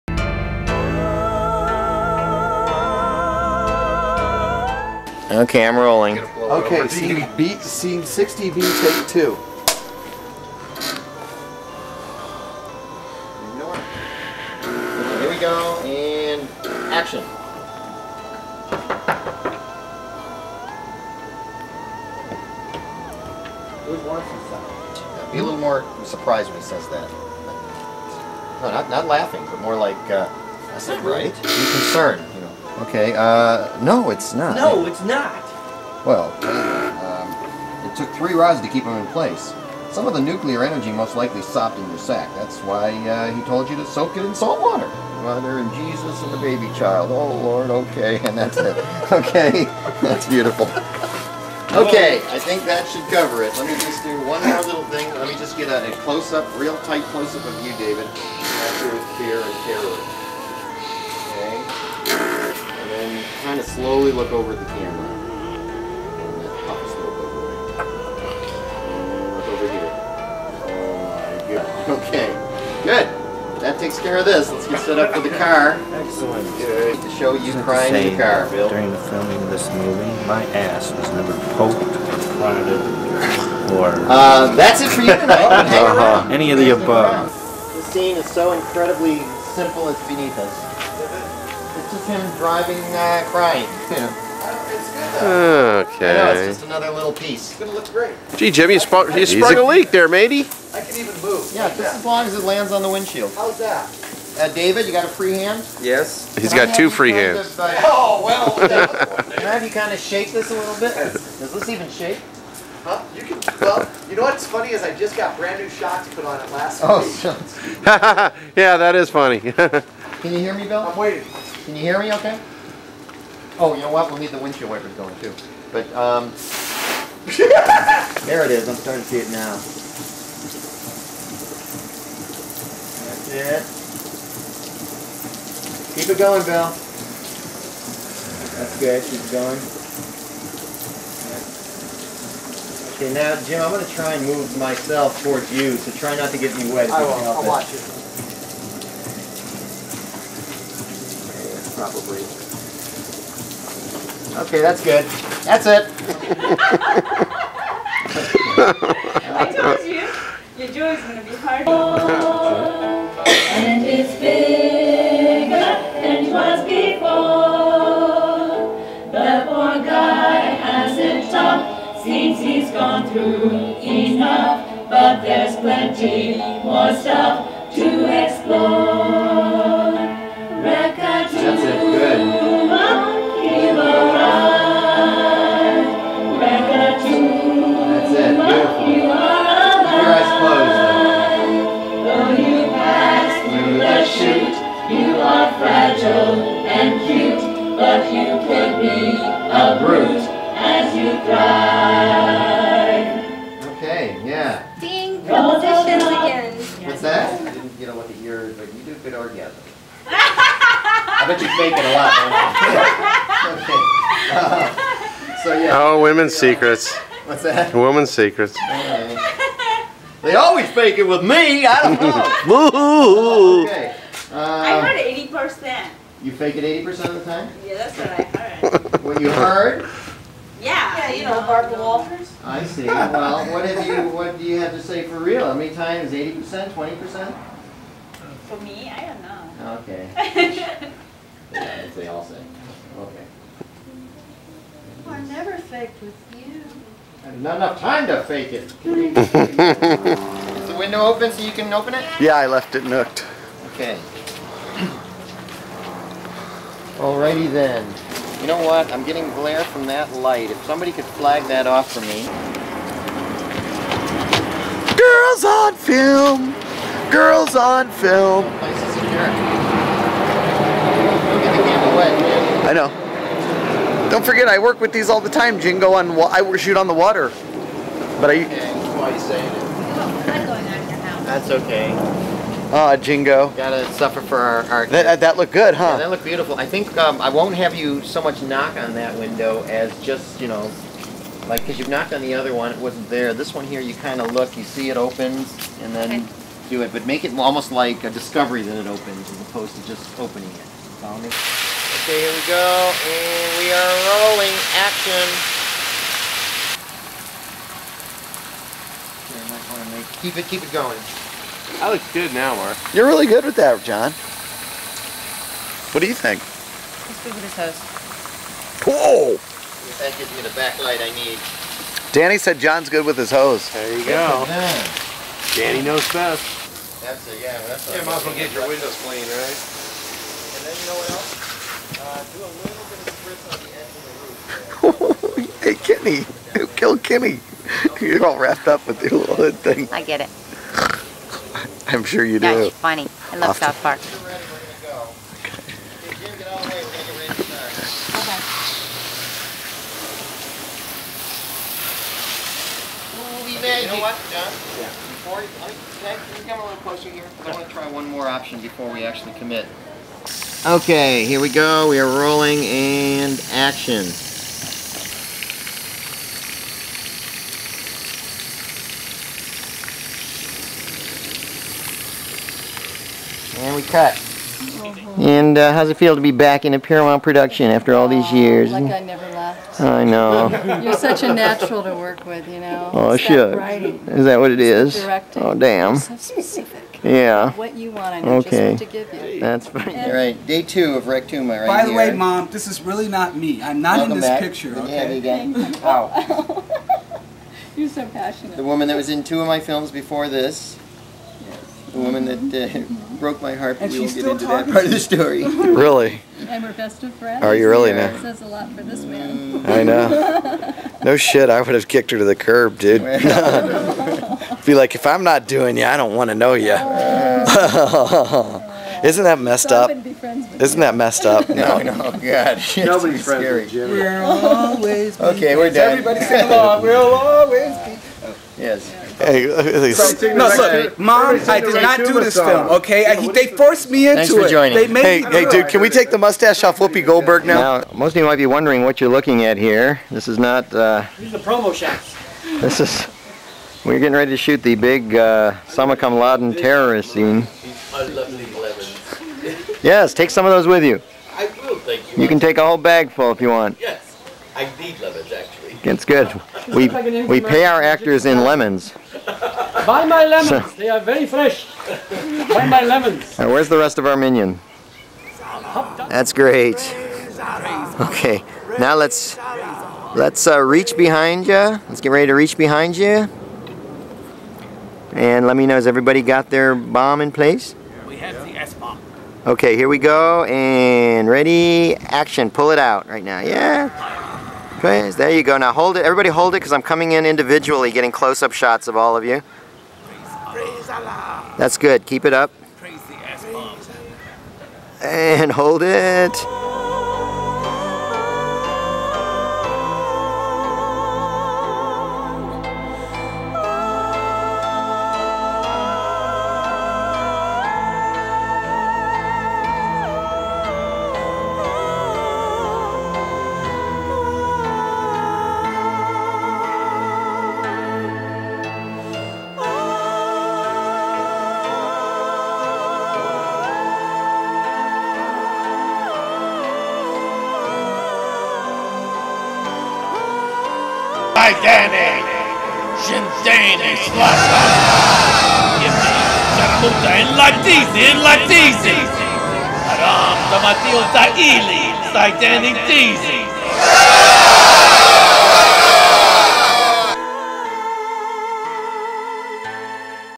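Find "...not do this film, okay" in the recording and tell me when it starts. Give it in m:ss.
7:11.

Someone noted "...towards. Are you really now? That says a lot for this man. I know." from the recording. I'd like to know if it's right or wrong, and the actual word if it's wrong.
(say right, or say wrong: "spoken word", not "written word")
wrong: "friends", not "towards".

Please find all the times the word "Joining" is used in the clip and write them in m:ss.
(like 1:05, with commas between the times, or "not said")
7:14.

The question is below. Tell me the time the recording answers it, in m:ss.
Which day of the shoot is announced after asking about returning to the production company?
6:30.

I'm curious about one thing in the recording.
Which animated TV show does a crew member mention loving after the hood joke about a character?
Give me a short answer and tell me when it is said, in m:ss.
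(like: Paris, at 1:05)
South Park, at 5:43.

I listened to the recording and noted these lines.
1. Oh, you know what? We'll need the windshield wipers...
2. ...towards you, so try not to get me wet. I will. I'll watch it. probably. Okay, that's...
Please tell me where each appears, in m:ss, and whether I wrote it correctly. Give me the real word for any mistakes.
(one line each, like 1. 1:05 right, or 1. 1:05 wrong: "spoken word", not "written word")
1. 2:03 right
2. 2:25 right.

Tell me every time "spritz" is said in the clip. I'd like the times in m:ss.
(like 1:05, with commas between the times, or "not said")
5:35.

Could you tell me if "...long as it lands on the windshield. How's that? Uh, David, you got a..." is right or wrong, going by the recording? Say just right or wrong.
right.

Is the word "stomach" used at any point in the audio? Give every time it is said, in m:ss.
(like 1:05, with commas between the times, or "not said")
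not said.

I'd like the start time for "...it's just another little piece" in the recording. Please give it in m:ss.
1:36.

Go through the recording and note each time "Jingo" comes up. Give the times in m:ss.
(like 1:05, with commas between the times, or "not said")
4:35, 4:42.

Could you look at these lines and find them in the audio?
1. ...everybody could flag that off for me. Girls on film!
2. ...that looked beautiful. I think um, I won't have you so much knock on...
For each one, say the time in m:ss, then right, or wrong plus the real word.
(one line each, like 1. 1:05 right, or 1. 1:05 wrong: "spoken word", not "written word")
1. 4:20 wrong: "somebody", not "everybody"
2. 4:45 right.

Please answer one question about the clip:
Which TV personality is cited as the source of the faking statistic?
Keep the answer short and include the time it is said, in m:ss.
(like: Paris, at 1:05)
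Barbara Walters, at 3:51.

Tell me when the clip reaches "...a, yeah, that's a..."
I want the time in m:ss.
5:27.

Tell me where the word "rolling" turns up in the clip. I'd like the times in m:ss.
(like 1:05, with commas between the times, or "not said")
0:05, 5:04, 6:02.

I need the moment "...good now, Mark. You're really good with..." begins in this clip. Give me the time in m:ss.
5:12.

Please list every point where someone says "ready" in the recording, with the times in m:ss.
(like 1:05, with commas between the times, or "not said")
7:24, 7:52, 8:01.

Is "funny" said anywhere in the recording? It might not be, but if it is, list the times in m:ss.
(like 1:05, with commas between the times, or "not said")
1:54, 1:59, 5:42.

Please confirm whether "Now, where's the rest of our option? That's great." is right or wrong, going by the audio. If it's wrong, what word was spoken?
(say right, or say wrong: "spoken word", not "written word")
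wrong: "minion", not "option".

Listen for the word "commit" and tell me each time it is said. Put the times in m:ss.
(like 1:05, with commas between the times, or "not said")
5:59.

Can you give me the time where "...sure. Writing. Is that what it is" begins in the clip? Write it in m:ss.
6:23.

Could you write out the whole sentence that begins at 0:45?
Mother and Jesus and the baby child.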